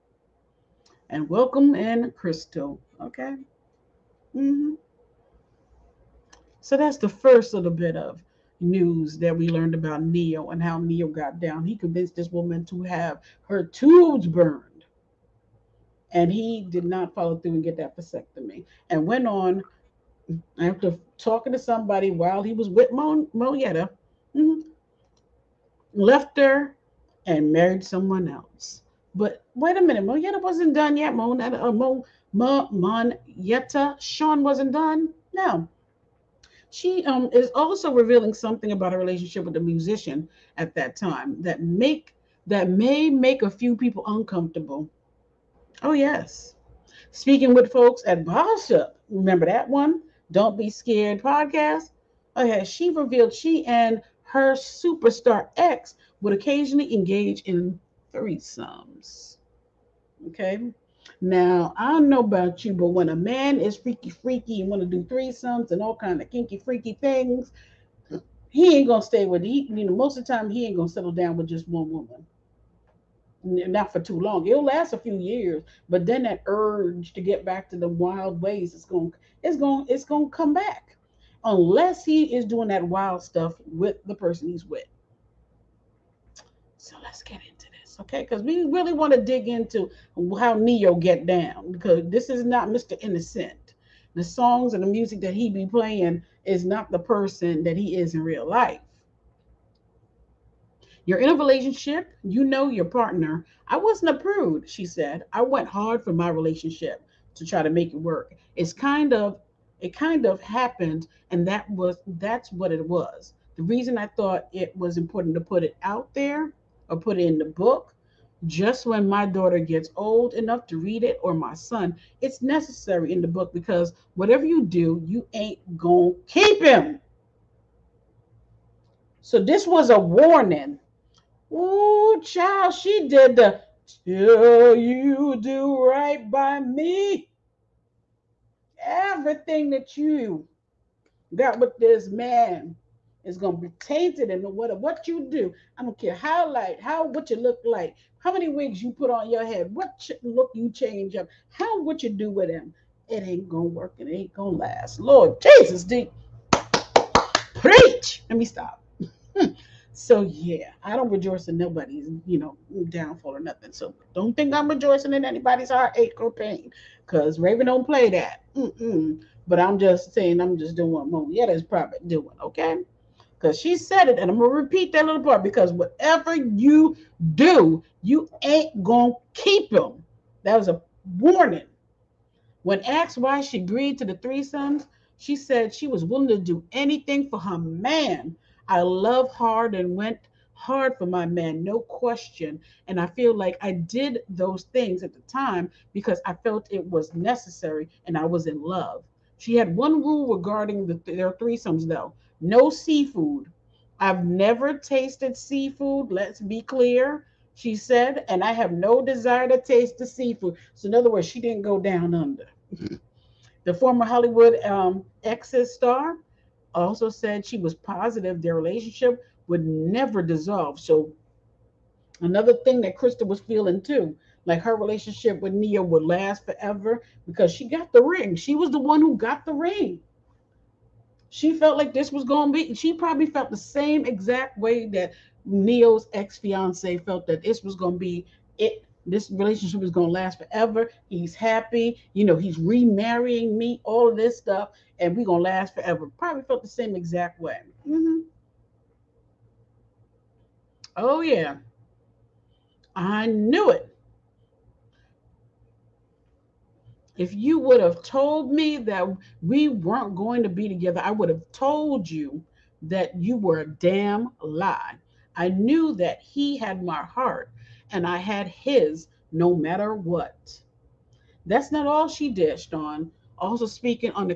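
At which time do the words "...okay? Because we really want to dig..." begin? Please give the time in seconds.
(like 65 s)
87 s.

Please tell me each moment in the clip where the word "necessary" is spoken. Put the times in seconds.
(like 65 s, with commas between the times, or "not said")
122 s, 197 s.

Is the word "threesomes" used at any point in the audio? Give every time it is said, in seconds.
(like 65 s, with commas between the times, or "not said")
58 s, 65 s, 184 s, 201 s.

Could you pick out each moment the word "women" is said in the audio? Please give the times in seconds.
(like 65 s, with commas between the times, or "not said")
not said.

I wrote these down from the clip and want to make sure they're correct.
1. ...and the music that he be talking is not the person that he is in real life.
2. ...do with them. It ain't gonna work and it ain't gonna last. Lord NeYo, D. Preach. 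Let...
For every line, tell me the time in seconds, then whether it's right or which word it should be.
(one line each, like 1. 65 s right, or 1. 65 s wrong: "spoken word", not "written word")
1. 94 s wrong: "playing", not "talking"
2. 152 s wrong: "Jesus", not "NeYo".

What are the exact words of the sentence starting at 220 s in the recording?
So, another thing that Krista was feeling too, like her relationship with Ne-Yo would last forever because she got the ring.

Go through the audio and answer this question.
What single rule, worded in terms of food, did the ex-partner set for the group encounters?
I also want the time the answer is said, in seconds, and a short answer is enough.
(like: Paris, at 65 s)
no seafood, at 202 s.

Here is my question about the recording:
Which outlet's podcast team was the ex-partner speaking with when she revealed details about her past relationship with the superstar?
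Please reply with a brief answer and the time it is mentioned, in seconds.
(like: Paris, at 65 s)
Boss Up, at 48 s.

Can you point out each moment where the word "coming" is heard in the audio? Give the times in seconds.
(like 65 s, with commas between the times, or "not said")
not said.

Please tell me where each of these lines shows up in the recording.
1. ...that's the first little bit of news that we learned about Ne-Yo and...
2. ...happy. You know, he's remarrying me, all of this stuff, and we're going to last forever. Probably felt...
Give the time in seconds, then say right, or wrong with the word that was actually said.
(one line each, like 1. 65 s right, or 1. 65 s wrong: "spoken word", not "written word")
1. 6 s right
2. 241 s right.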